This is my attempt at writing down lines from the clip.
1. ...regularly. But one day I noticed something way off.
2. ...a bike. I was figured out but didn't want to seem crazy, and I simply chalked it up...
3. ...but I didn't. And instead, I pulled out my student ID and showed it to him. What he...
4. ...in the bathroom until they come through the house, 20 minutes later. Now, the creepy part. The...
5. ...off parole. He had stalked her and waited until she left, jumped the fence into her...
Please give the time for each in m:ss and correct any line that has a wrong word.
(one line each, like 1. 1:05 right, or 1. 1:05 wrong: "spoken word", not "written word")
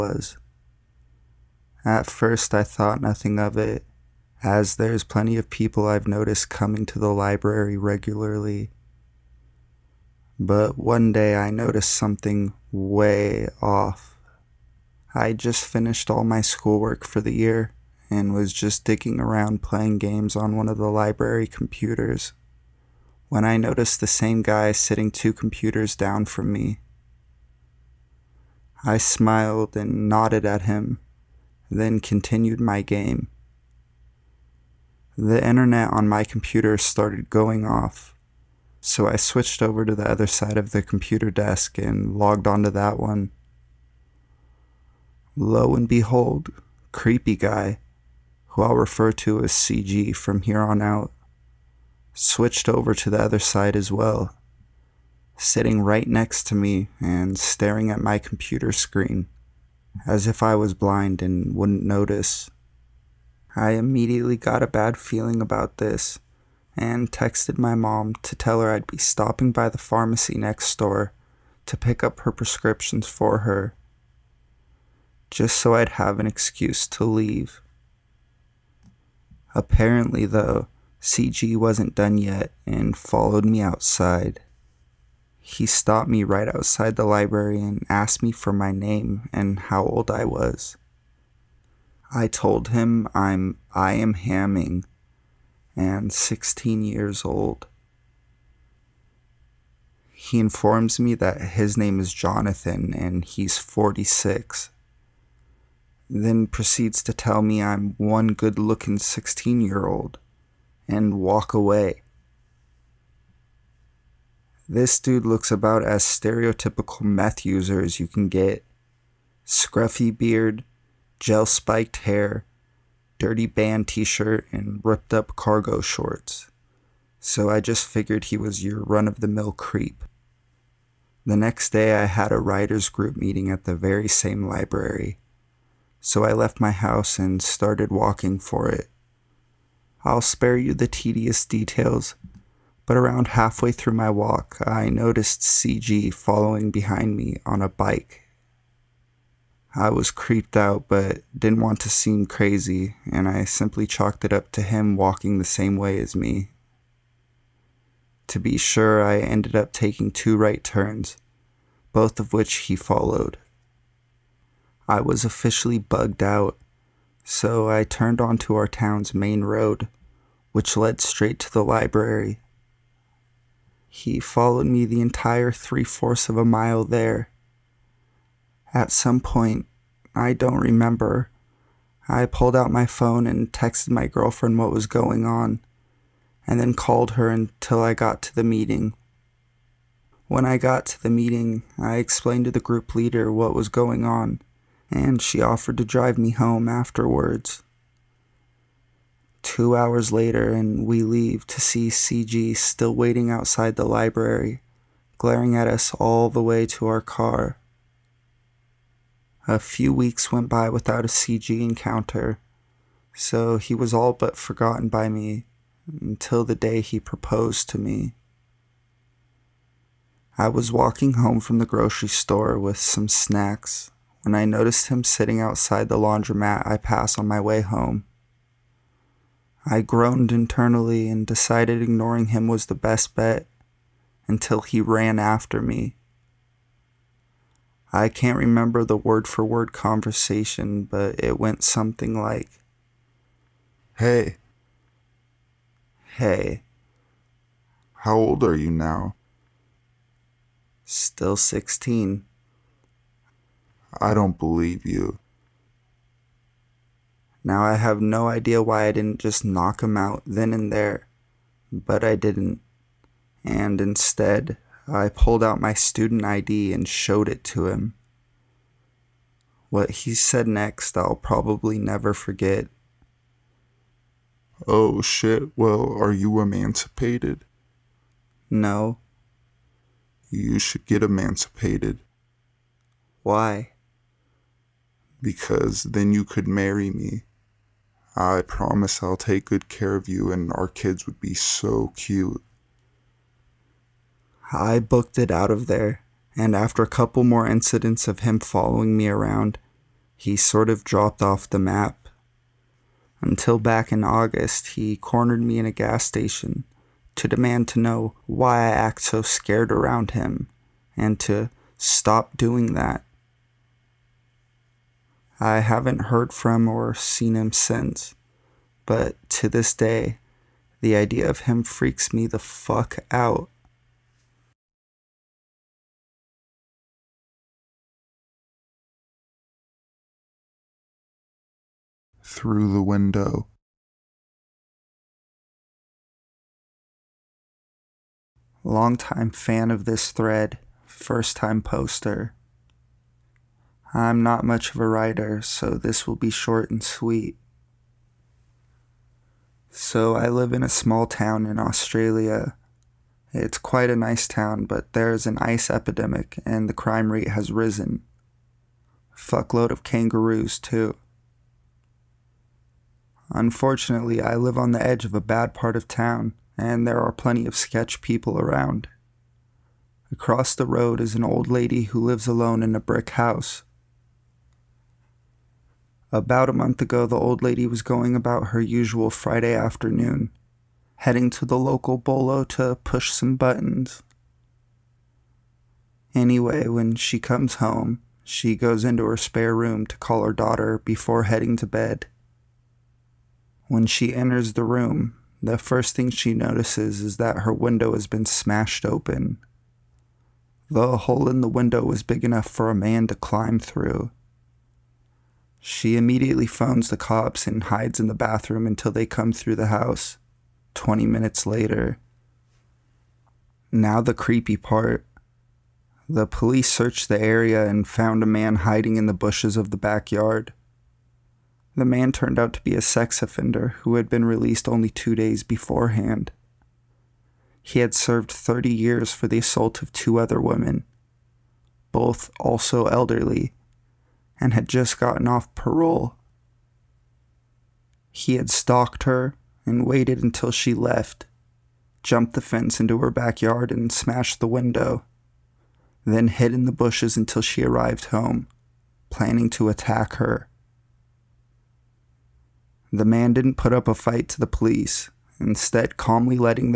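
1. 0:07 right
2. 2:27 wrong: "creeped", not "figured"
3. 4:21 right
4. 6:48 right
5. 7:15 right.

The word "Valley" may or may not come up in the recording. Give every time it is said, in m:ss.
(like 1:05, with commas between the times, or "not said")
not said.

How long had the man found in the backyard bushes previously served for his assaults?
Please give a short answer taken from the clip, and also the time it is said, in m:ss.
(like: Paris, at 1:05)
30 years, at 7:08.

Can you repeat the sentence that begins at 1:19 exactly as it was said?
Apparently, though, CG wasn't done yet and followed me outside.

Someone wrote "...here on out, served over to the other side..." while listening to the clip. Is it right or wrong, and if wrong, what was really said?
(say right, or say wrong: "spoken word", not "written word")
wrong: "switched", not "served".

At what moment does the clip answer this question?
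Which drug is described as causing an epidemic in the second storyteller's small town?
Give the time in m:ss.
5:55.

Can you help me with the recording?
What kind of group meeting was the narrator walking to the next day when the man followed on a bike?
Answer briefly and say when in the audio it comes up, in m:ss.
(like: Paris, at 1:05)
writers group, at 2:12.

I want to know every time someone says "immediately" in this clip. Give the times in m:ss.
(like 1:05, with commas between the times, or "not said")
1:03, 6:45.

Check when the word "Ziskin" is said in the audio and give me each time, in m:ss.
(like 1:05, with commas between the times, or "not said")
not said.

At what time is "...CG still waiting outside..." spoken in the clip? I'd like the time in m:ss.
3:21.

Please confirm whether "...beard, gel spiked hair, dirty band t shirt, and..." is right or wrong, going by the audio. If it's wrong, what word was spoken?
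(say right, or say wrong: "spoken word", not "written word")
right.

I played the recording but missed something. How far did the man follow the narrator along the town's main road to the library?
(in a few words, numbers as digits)
3/4 of a mile.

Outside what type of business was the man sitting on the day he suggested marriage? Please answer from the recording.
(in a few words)
laundromat.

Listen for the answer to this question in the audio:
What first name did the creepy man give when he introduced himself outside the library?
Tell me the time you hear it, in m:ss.
1:42.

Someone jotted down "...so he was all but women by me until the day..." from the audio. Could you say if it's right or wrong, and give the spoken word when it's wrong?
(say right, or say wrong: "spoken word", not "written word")
wrong: "forgotten", not "women".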